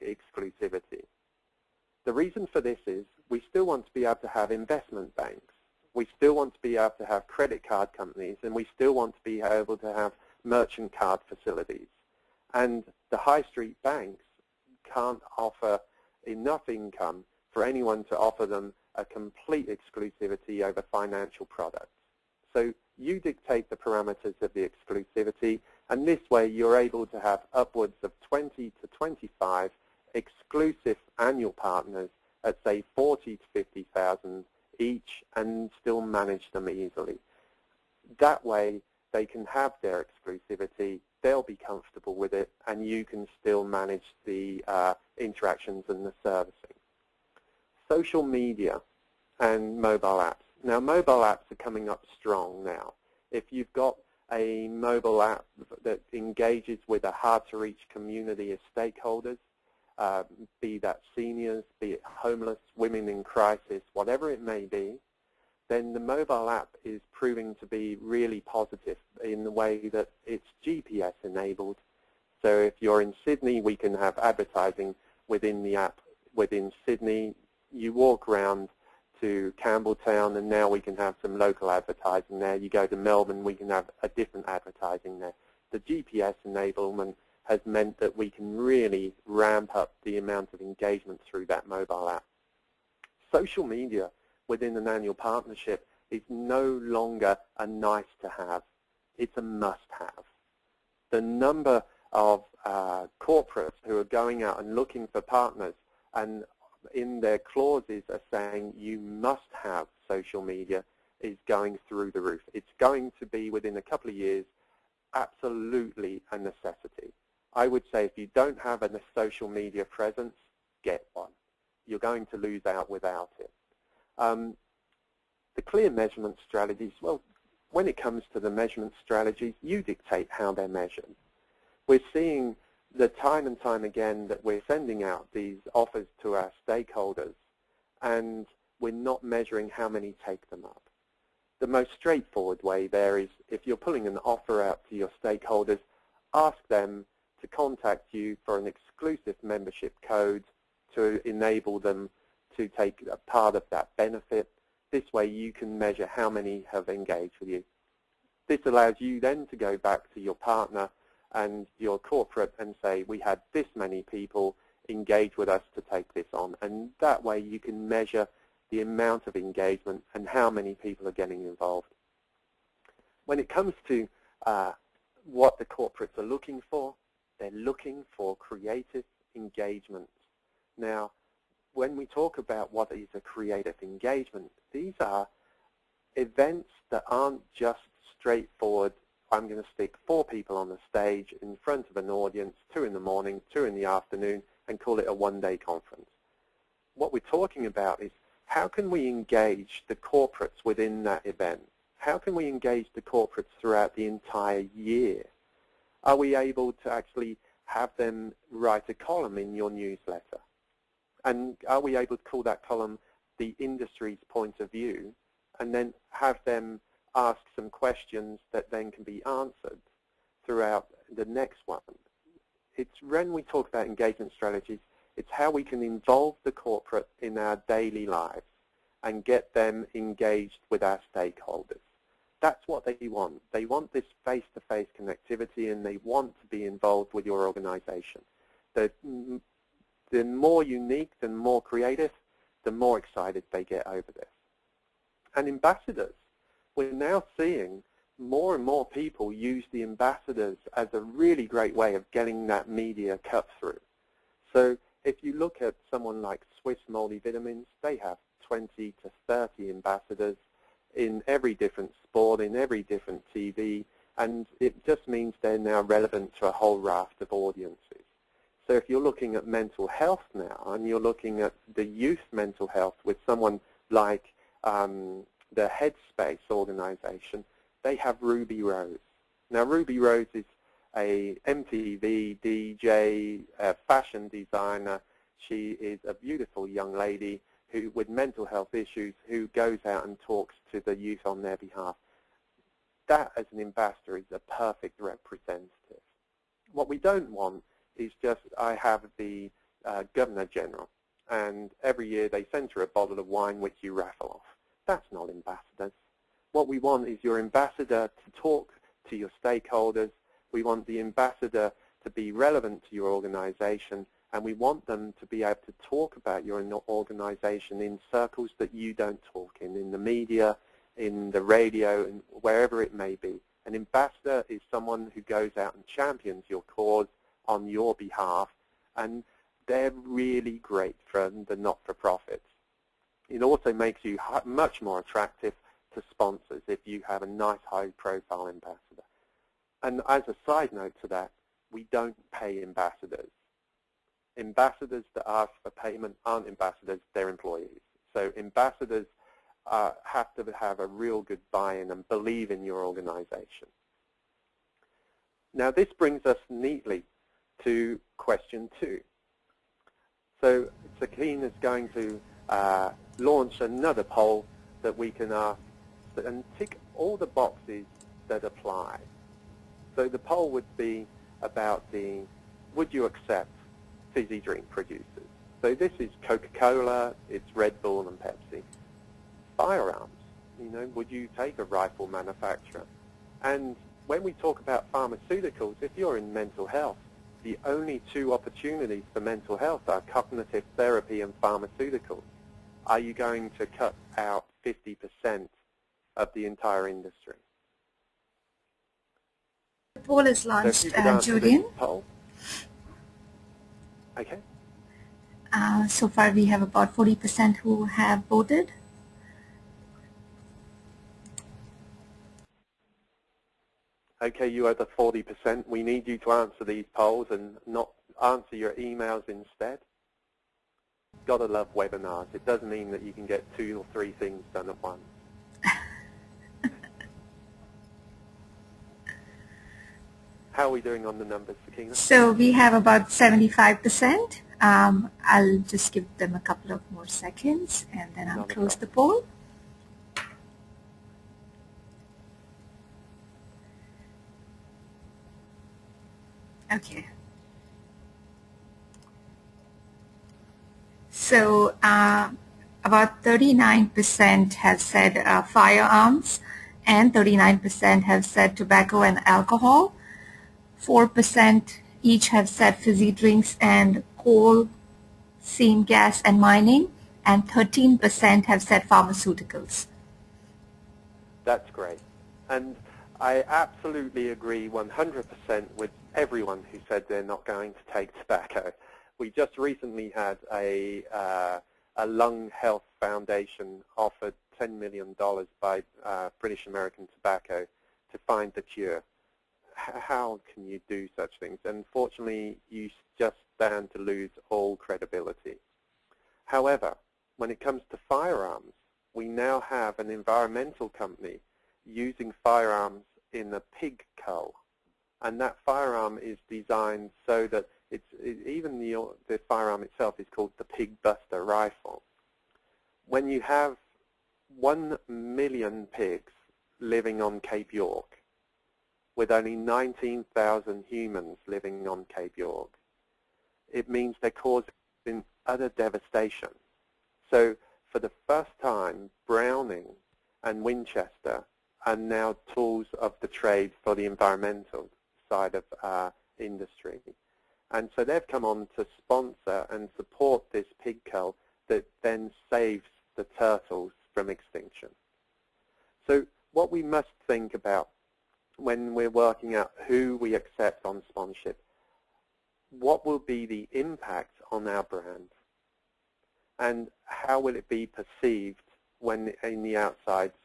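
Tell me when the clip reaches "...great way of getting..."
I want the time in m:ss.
4:11.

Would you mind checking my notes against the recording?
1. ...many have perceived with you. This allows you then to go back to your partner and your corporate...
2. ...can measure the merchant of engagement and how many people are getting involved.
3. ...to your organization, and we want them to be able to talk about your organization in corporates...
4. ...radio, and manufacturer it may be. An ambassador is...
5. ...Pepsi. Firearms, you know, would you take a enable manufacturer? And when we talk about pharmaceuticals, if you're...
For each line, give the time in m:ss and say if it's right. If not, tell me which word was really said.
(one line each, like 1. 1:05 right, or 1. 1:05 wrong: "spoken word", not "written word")
1. 2:36 wrong: "engaged", not "perceived"
2. 2:47 wrong: "amount", not "merchant"
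3. 5:12 wrong: "circles", not "corporates"
4. 5:21 wrong: "wherever", not "manufacturer"
5. 6:18 wrong: "rifle", not "enable".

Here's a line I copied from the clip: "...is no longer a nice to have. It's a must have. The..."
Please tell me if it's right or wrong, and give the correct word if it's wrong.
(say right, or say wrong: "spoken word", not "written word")
right.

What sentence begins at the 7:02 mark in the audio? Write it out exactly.
It does mean that you can get two or three things done at once.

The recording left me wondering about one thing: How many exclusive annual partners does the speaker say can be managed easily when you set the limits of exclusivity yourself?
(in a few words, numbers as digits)
20 to 25.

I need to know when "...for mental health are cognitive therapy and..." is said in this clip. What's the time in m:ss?
6:29.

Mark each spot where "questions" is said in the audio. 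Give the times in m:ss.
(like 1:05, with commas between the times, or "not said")
3:37, 5:58.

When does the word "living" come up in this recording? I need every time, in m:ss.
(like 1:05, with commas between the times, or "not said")
8:36, 8:41.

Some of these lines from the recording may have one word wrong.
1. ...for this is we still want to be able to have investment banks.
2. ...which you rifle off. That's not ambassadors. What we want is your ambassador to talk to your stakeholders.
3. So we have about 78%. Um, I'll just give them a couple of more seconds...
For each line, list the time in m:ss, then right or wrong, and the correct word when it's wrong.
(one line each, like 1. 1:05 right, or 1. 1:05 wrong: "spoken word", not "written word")
1. 0:02 right
2. 5:03 wrong: "raffle", not "rifle"
3. 7:11 wrong: "75", not "78".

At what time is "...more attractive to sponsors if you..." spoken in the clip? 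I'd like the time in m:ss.
5:34.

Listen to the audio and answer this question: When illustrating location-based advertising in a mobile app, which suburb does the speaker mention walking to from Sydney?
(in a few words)
Campbelltown.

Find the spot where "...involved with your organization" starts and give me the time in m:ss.
3:56.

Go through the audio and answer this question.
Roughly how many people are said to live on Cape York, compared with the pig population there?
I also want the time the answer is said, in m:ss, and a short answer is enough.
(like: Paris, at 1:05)
19,000, at 8:39.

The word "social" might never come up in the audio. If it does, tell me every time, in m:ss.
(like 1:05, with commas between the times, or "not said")
0:47, 1:33, 1:50, 1:59.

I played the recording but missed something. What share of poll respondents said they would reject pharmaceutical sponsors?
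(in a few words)
13%.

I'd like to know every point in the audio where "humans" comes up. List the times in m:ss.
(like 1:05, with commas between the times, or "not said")
8:40.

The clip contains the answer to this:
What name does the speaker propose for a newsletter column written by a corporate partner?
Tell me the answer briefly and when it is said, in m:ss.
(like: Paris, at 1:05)
the industry's point of view, at 3:33.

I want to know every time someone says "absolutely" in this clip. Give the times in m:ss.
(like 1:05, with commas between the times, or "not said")
1:55, 7:53.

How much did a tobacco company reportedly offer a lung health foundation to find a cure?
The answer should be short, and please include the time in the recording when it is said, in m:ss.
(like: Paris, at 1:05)
$10 million, at 8:04.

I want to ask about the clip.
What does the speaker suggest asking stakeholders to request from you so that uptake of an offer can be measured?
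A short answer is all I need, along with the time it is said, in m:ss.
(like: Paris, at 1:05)
exclusive membership code, at 2:28.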